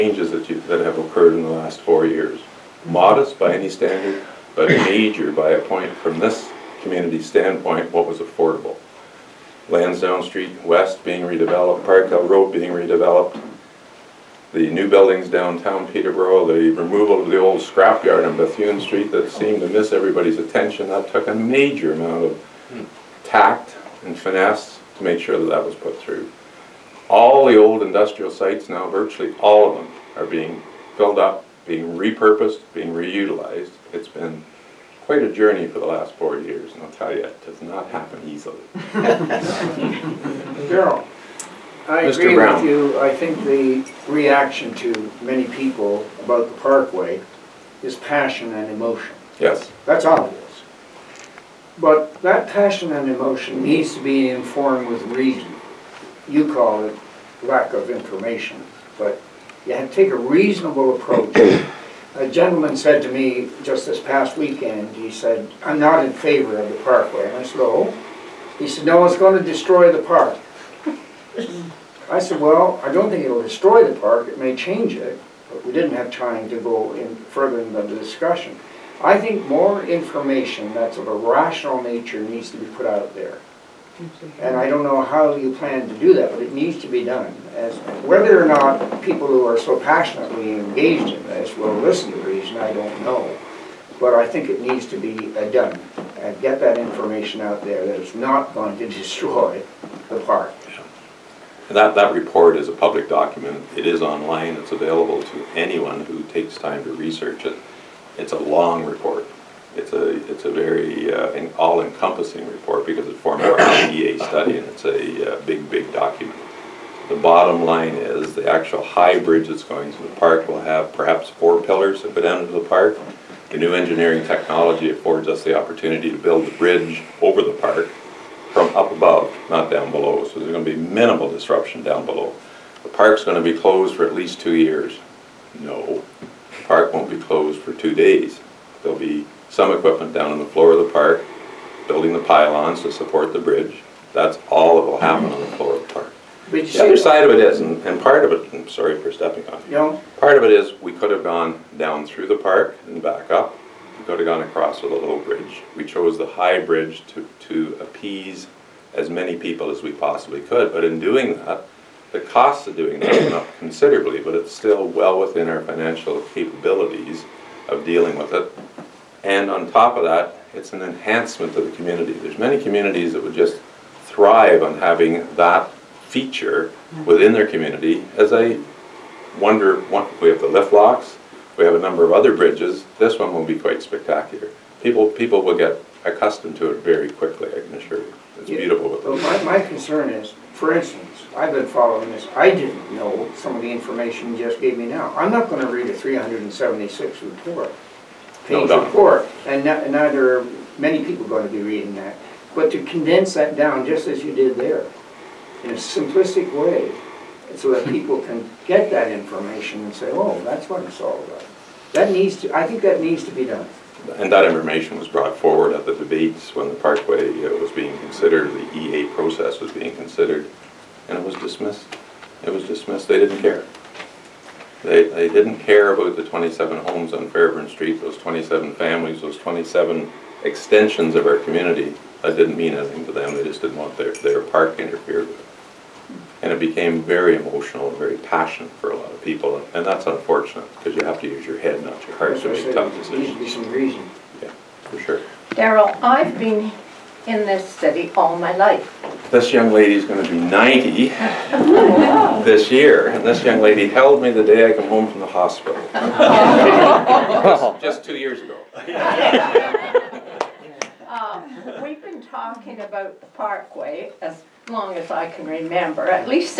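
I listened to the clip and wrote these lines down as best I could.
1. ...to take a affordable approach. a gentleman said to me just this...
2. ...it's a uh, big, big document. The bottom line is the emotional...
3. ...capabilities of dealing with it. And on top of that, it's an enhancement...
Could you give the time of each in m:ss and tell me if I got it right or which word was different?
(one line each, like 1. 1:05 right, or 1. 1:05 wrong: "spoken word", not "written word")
1. 0:59 wrong: "reasonable", not "affordable"
2. 1:54 wrong: "actual", not "emotional"
3. 2:46 right.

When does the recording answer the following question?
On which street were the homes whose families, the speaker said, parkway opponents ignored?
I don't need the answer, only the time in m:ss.
3:47.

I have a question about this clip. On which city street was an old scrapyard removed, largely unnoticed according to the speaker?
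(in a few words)
Bethune Street.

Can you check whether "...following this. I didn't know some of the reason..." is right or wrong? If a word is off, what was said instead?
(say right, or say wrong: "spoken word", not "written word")
wrong: "information", not "reason".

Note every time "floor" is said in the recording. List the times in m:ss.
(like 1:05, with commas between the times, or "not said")
2:20, 2:25.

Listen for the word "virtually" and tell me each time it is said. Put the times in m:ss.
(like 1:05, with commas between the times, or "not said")
0:28.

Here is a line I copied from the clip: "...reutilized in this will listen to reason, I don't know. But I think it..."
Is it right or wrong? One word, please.
wrong.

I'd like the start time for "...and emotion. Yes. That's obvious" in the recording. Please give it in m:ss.
0:48.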